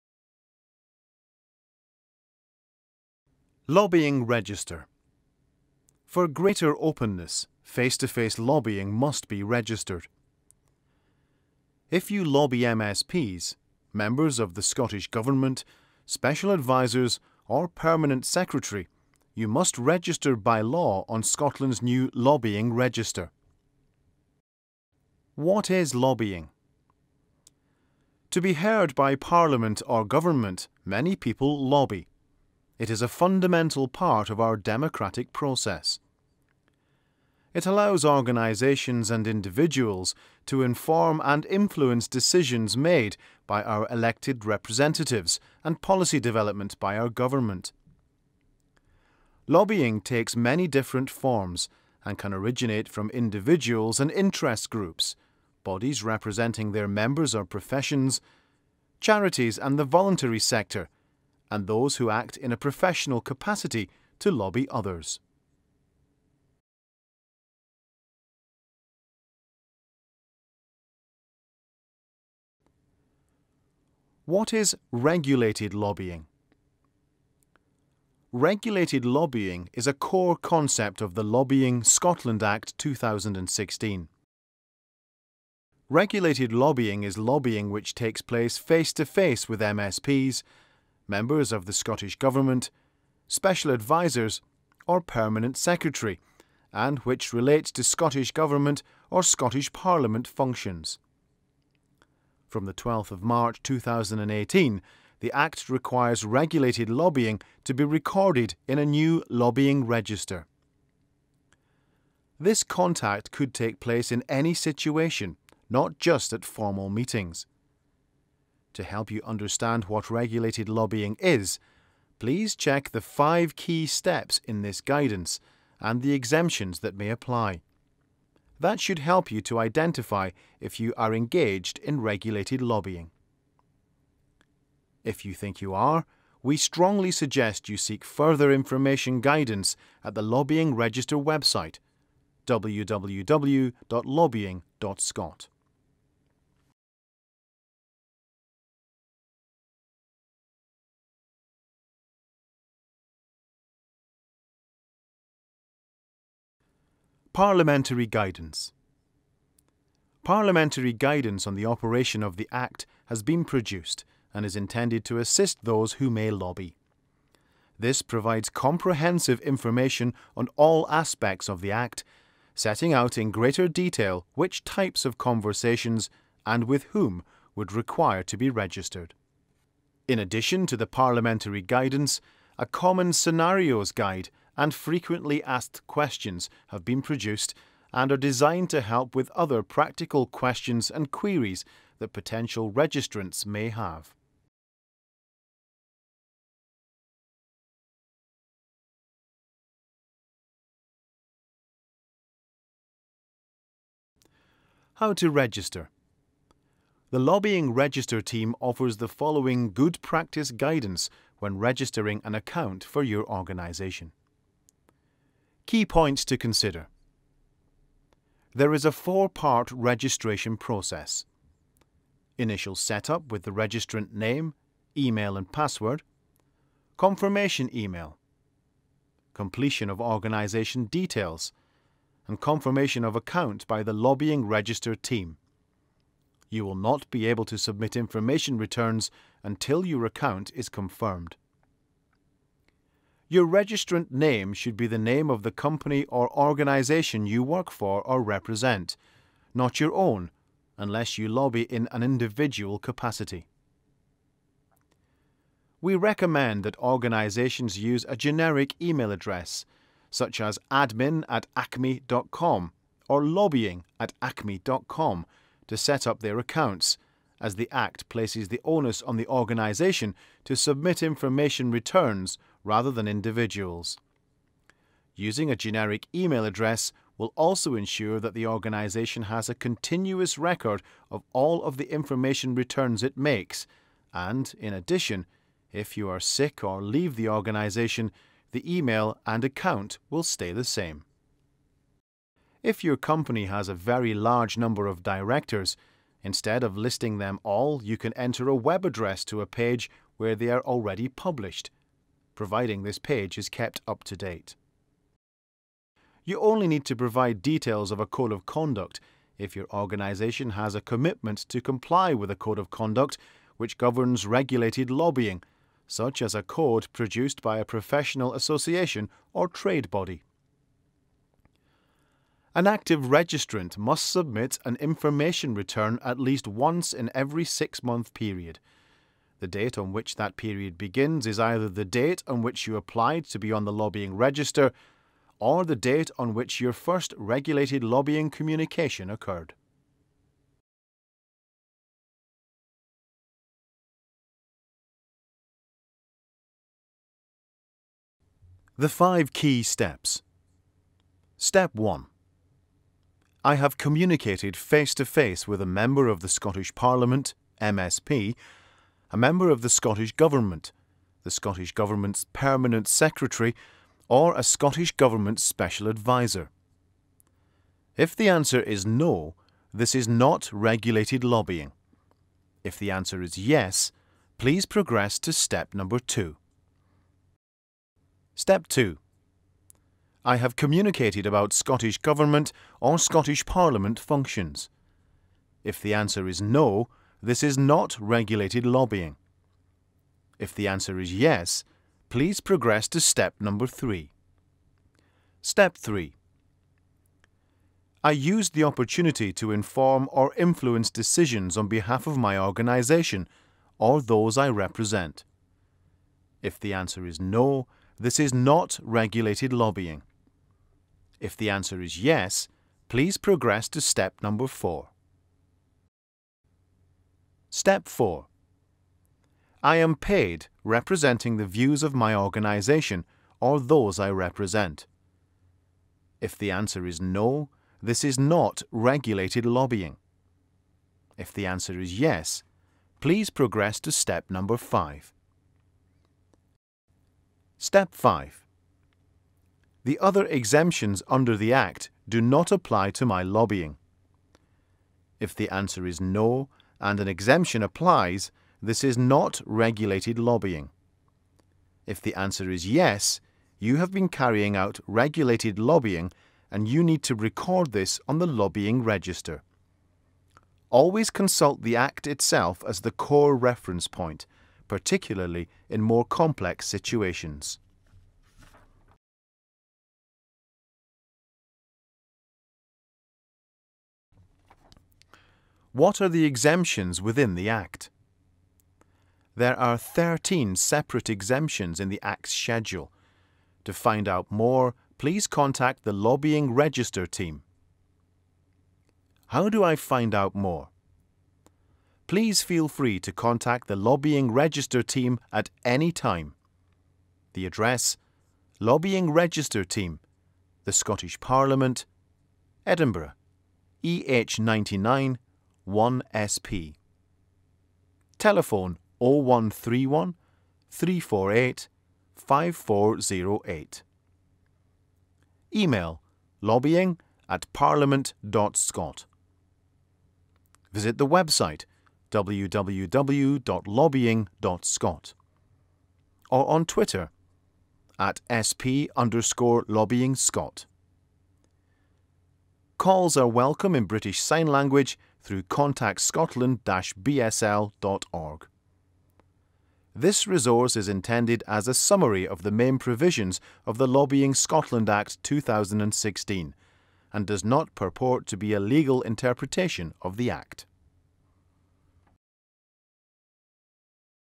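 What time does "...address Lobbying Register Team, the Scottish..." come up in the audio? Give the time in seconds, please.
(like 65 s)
497 s.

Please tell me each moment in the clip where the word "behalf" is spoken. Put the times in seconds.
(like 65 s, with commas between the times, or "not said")
401 s.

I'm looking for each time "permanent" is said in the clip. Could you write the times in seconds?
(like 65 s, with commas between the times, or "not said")
17 s, 95 s, 362 s.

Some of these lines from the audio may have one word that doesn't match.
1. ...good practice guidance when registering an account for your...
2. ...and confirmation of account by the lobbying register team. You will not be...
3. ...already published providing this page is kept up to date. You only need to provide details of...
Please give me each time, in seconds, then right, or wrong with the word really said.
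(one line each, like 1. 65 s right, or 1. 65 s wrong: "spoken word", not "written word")
1. 209 s right
2. 232 s right
3. 300 s right.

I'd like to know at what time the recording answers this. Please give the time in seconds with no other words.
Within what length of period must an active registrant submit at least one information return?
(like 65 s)
327 s.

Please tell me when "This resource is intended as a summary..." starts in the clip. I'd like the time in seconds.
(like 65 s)
539 s.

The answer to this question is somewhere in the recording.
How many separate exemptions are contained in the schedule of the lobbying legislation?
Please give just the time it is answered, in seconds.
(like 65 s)
479 s.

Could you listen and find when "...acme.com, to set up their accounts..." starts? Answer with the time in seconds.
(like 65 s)
264 s.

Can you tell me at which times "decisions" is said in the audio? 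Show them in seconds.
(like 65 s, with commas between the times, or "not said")
42 s, 400 s.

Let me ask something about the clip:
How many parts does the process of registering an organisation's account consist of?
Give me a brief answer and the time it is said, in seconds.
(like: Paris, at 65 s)
4, at 218 s.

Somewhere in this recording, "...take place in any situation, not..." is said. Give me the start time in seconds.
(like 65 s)
113 s.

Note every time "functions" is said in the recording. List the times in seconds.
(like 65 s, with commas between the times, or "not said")
100 s, 383 s.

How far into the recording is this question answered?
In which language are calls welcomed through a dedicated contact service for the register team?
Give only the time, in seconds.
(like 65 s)
533 s.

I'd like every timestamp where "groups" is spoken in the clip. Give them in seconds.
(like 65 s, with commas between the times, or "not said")
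54 s.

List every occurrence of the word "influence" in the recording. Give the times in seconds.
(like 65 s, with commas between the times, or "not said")
41 s, 400 s.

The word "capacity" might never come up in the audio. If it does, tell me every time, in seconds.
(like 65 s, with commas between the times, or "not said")
63 s, 252 s.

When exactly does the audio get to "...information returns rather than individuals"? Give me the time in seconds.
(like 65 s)
271 s.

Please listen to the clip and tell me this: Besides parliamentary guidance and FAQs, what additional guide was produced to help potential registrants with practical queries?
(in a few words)
common scenarios guide.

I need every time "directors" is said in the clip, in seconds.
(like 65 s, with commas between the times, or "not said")
295 s.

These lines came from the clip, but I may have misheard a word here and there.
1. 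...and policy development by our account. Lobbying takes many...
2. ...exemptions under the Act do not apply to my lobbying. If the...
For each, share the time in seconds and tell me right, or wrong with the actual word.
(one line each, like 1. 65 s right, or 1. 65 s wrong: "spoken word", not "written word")
1. 45 s wrong: "government", not "account"
2. 440 s right.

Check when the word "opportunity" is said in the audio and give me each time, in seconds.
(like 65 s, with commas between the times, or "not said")
398 s.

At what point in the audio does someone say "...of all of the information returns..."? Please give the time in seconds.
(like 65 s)
281 s.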